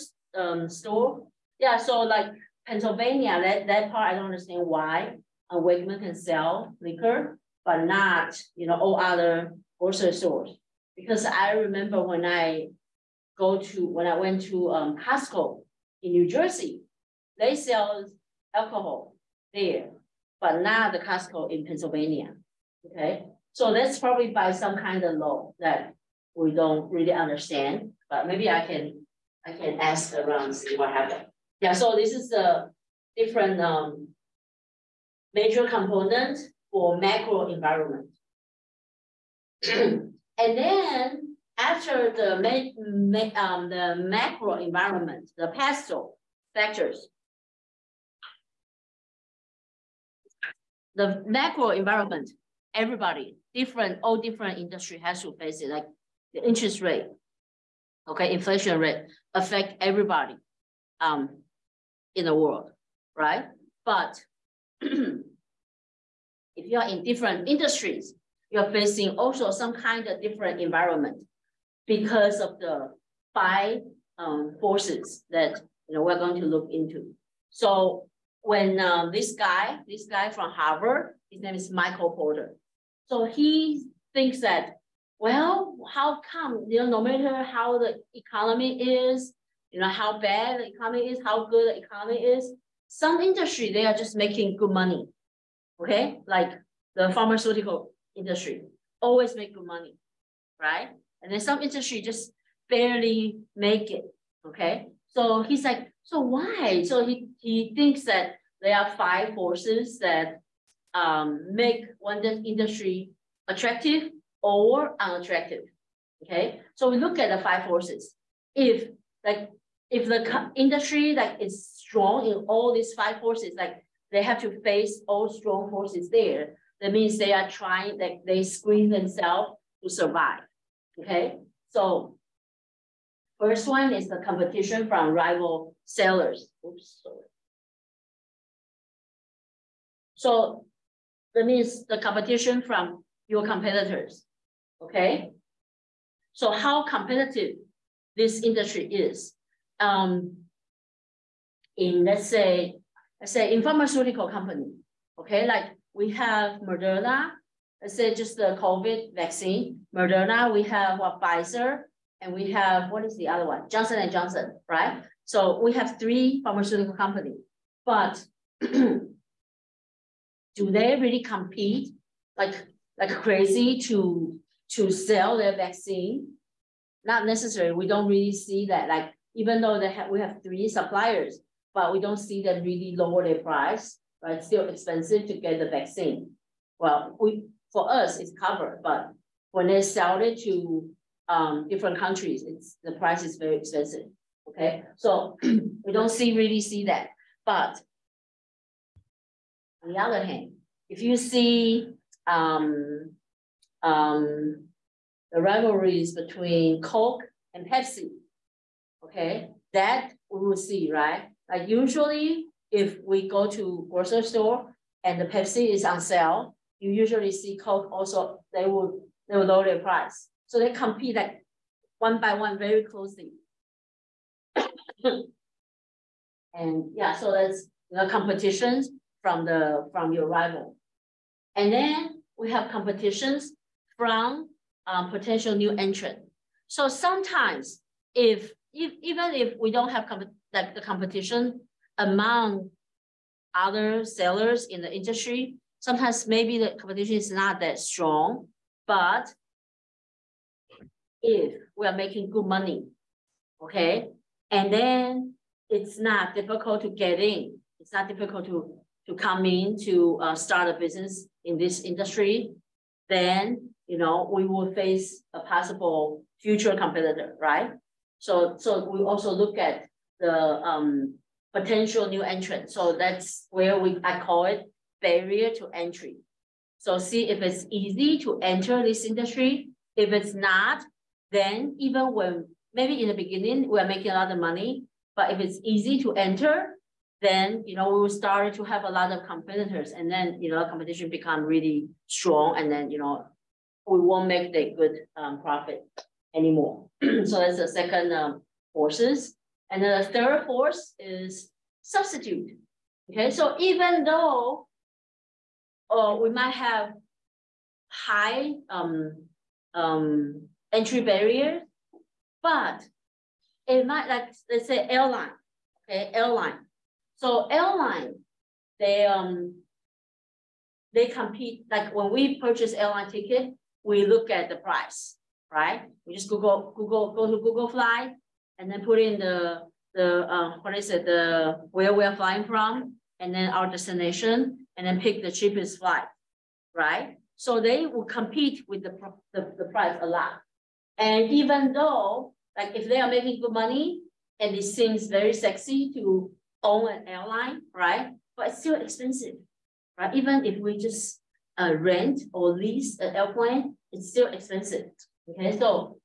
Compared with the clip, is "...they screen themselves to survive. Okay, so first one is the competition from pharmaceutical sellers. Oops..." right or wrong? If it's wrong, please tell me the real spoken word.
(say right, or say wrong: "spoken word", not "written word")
wrong: "rival", not "pharmaceutical".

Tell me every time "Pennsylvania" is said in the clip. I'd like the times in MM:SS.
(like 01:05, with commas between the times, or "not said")
00:02, 00:21.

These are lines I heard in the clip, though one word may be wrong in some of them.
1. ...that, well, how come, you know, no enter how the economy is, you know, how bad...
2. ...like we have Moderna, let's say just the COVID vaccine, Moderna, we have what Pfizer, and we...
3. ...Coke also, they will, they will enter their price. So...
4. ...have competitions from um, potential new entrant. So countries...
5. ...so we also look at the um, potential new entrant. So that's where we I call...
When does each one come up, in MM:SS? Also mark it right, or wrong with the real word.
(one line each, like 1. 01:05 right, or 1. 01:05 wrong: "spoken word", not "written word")
1. 01:24 wrong: "matter", not "enter"
2. 02:35 right
3. 03:37 wrong: "lower", not "enter"
4. 03:52 wrong: "sometimes", not "countries"
5. 04:28 right.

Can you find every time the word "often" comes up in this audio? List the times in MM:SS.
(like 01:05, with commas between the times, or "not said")
not said.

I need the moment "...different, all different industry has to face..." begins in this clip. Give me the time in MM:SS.
00:53.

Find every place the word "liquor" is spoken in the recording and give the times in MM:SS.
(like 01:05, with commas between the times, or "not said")
00:06.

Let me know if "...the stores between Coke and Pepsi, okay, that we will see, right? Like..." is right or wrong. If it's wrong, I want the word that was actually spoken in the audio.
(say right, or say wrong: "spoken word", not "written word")
wrong: "rivalries", not "stores".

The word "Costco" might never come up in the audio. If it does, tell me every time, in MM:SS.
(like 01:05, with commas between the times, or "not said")
00:14, 00:20.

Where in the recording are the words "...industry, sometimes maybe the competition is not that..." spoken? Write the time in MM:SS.
04:04.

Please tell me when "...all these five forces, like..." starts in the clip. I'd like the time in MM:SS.
02:02.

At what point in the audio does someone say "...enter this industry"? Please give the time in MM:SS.
04:38.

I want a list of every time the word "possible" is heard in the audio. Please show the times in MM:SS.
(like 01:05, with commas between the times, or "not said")
04:25.